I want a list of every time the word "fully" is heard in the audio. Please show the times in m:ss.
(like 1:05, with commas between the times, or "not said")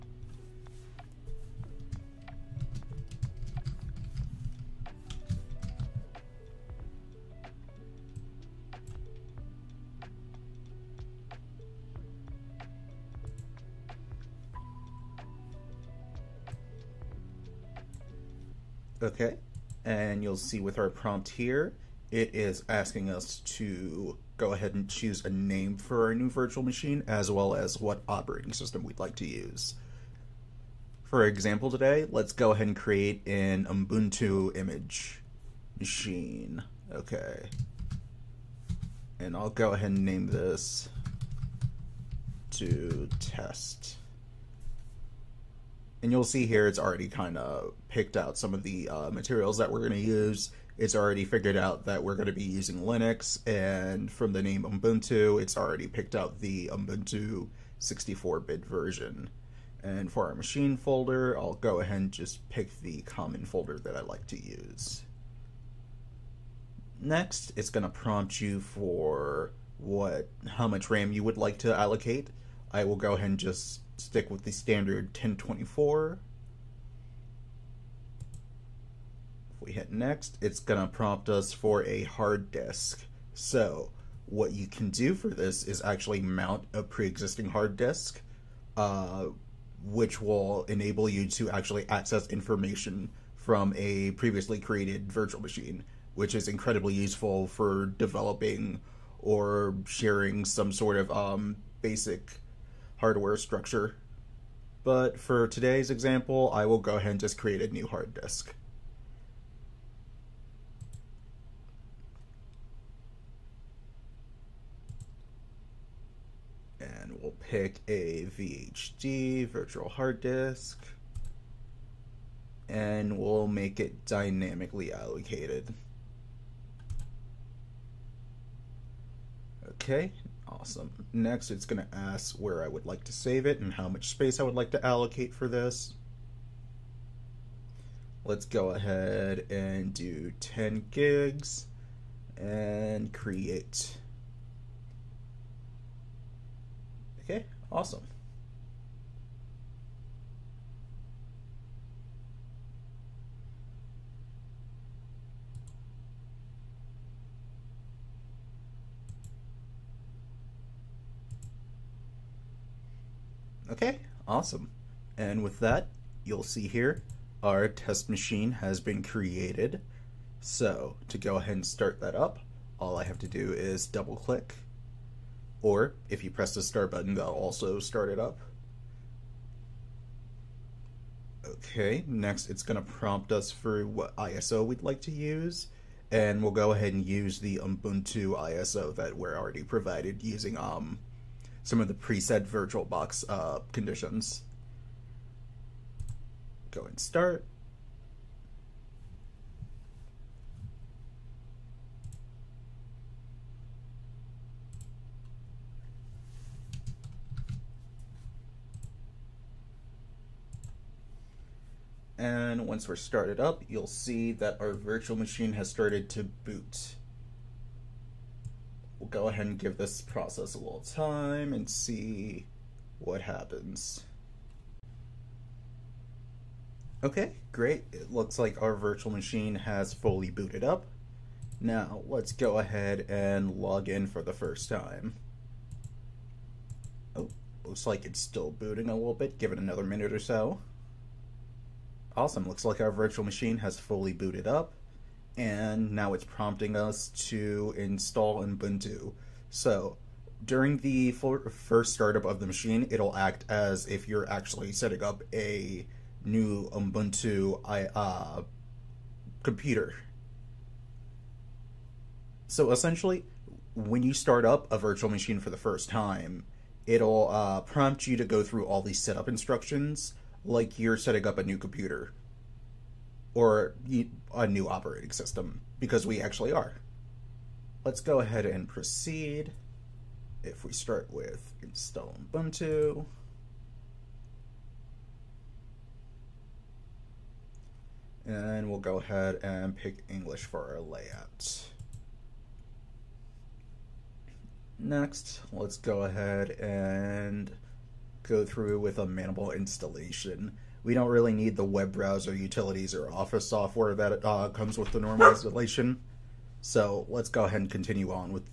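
3:49, 4:03.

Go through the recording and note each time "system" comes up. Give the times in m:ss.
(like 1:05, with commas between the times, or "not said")
0:28, 4:35.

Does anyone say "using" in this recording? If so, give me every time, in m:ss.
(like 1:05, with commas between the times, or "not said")
0:52, 3:10.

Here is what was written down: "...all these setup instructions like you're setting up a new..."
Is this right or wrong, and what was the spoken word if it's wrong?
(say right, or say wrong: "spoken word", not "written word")
right.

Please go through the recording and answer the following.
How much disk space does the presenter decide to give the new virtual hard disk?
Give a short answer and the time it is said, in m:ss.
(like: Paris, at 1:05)
10 gigs, at 2:20.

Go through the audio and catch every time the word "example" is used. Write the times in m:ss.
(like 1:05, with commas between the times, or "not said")
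0:31, 1:45.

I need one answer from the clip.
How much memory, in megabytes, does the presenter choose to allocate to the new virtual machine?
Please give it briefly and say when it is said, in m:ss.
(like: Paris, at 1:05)
1024, at 1:15.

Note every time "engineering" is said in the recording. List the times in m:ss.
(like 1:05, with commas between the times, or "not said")
not said.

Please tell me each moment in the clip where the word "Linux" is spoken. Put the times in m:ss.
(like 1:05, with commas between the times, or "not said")
0:52.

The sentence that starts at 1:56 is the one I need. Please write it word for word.
And we'll pick a VHD, virtual hard disk, and we'll make it dynamically allocated.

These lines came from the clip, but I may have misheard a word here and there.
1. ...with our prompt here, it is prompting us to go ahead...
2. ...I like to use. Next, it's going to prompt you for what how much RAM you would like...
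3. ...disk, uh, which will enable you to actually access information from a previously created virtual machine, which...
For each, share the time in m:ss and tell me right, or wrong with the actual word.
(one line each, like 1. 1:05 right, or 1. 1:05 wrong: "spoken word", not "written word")
1. 0:20 wrong: "asking", not "prompting"
2. 1:03 right
3. 1:27 right.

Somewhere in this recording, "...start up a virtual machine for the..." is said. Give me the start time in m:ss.
4:24.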